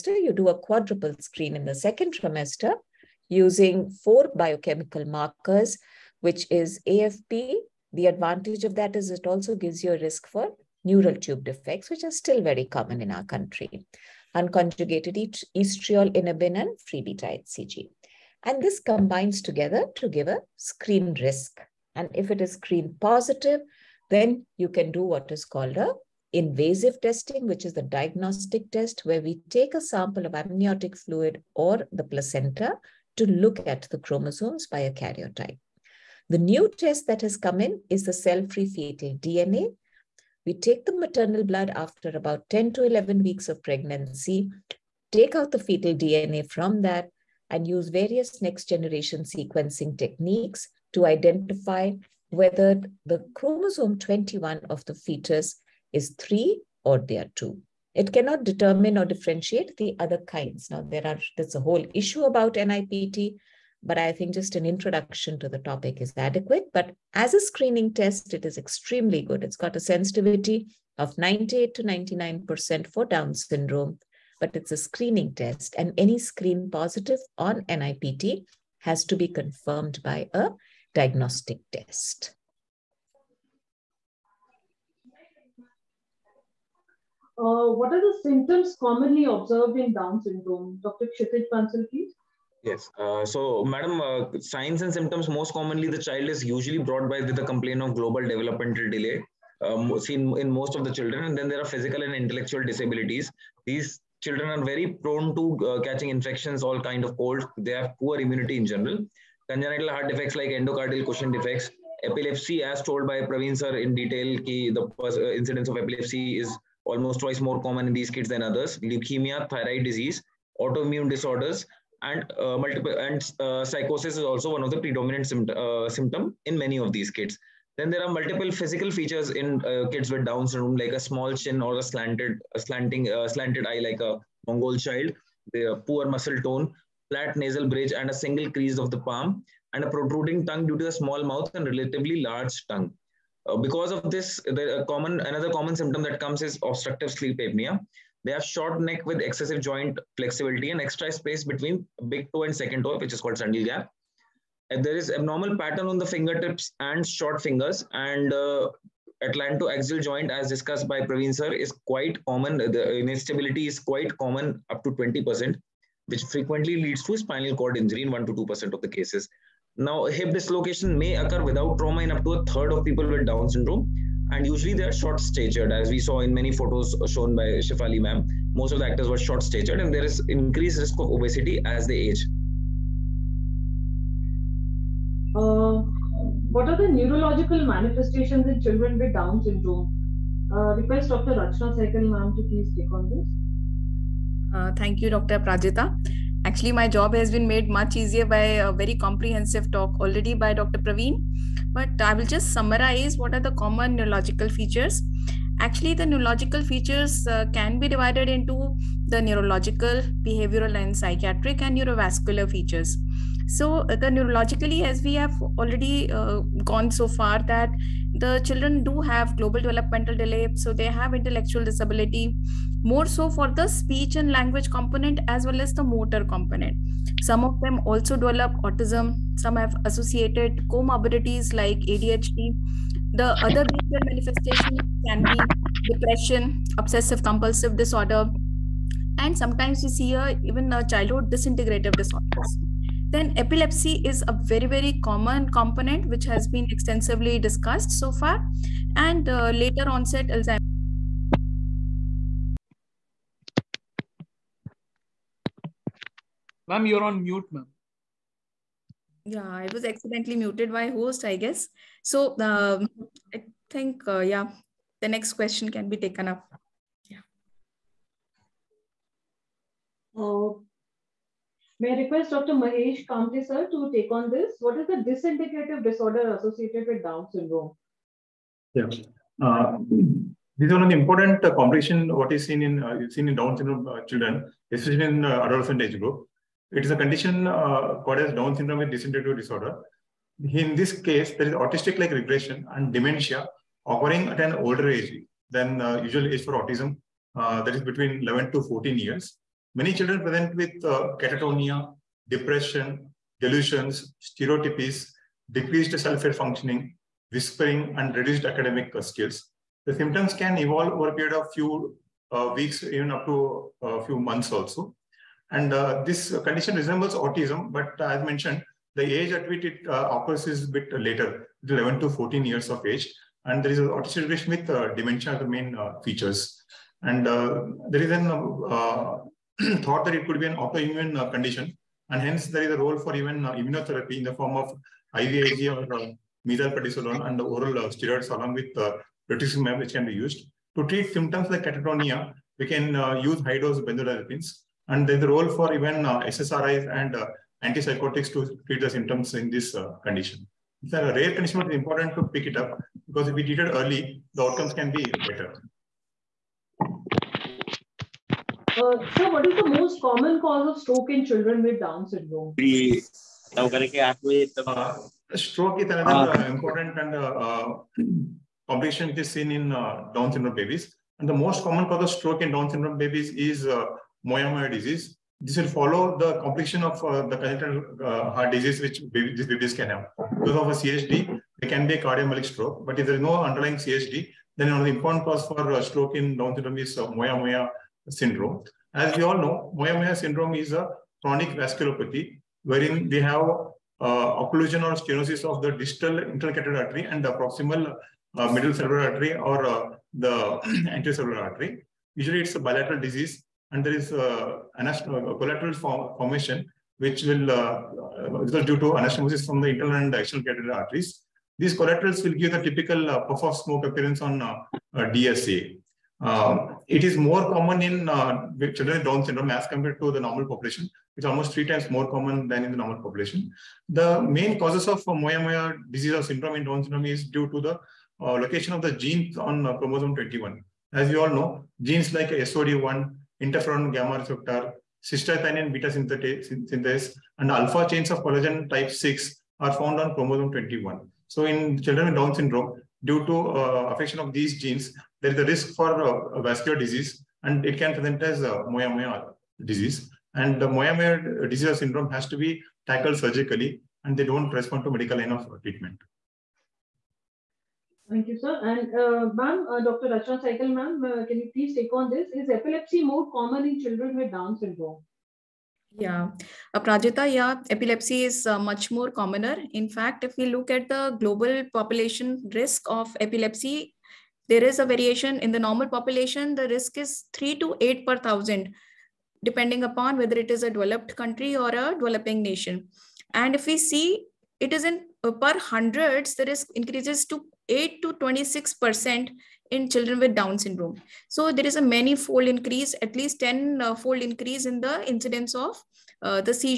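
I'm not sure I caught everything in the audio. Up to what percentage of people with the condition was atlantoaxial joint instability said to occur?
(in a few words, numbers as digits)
20%.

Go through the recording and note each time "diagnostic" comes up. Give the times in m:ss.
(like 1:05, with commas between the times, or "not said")
0:27, 1:20.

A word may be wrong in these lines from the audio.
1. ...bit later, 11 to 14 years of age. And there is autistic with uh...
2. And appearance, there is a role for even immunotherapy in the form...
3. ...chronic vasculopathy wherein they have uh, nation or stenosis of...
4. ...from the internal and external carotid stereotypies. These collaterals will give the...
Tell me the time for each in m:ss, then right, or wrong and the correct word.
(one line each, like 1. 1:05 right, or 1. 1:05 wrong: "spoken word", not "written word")
1. 5:20 right
2. 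5:32 wrong: "hence", not "appearance"
3. 6:31 wrong: "occlusion", not "nation"
4. 6:49 wrong: "arteries", not "stereotypies".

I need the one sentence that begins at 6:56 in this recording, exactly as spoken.
Um, it is more common in uh, children with Down syndrome as compared to the normal population.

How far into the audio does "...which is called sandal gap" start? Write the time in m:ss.
2:32.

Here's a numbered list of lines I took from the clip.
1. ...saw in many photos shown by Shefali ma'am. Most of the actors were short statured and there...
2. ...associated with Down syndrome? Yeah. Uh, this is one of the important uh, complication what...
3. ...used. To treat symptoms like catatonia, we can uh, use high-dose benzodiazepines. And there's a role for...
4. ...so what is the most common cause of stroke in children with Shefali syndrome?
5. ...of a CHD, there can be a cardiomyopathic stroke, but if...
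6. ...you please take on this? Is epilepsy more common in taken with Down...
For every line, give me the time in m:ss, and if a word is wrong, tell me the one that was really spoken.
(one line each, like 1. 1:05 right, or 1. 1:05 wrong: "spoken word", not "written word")
1. 2:55 right
2. 4:36 right
3. 5:40 right
4. 5:59 wrong: "Down", not "Shefali"
5. 6:20 right
6. 7:41 wrong: "children", not "taken".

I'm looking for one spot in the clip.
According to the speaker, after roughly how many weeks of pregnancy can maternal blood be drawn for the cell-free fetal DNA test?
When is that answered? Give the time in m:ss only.
0:42.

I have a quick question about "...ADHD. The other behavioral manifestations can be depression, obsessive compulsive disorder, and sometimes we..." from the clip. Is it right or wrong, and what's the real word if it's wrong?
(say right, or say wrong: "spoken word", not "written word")
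right.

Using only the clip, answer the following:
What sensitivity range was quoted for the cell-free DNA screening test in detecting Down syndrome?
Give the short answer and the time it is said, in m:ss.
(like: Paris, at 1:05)
98 to 99%, at 1:11.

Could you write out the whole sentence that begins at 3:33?
So uh, the neurologically, as we have already uh, gone so far that the children do have global developmental delay.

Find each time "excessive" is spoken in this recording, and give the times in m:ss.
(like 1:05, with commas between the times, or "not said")
2:29.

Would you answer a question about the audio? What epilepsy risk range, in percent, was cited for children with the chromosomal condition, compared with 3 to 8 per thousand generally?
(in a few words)
8 to 26%.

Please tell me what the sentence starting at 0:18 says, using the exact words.
And this combines together to give a screen risk.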